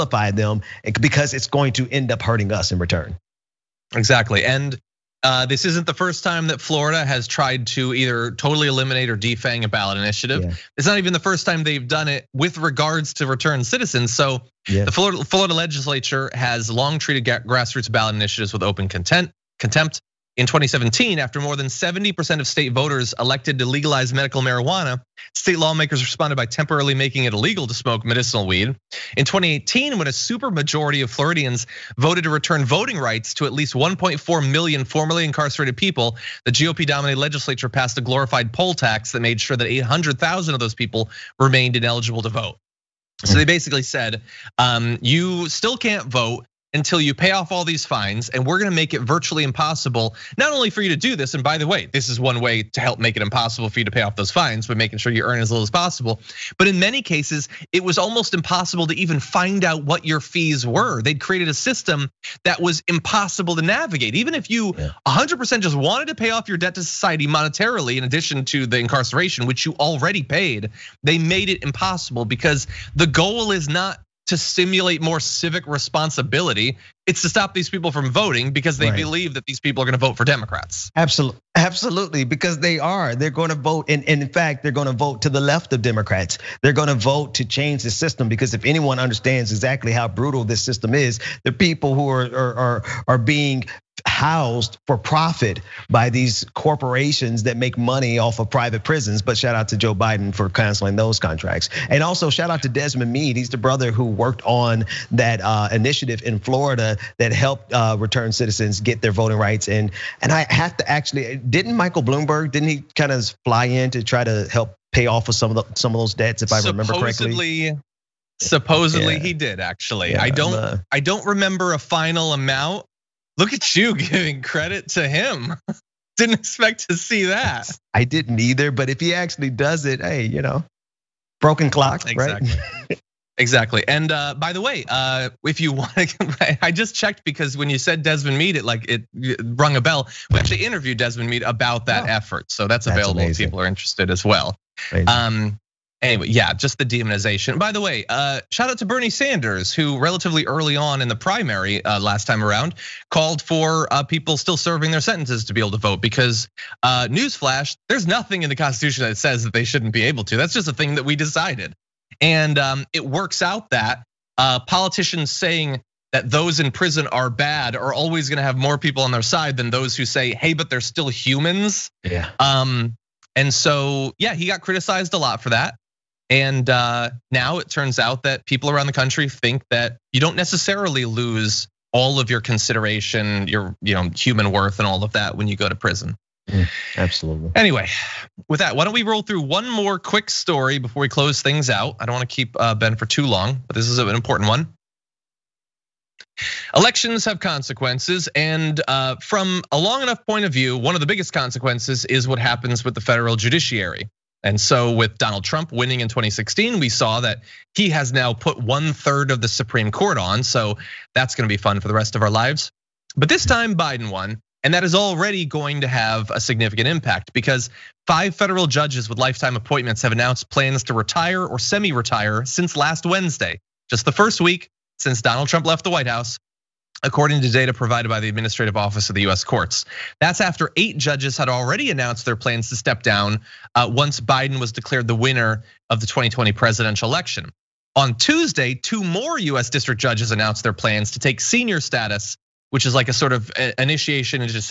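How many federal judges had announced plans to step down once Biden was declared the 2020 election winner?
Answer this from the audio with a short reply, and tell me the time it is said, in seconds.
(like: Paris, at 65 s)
8, at 230 s.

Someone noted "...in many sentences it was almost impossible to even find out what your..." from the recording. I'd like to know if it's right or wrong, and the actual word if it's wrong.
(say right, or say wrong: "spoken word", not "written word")
wrong: "cases", not "sentences".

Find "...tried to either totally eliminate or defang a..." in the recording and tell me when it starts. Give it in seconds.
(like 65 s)
7 s.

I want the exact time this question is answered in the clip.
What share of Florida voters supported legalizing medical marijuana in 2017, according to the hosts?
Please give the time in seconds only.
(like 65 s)
21 s.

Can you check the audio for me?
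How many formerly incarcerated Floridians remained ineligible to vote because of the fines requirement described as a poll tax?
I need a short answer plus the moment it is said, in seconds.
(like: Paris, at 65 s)
800,000, at 39 s.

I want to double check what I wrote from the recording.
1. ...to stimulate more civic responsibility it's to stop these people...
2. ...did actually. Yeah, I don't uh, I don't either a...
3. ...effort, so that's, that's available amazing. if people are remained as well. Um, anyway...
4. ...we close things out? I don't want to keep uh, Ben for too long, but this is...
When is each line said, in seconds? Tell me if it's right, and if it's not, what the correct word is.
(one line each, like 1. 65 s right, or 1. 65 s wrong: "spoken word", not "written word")
1. 74 s right
2. 119 s wrong: "remember", not "either"
3. 142 s wrong: "interested", not "remained"
4. 191 s right.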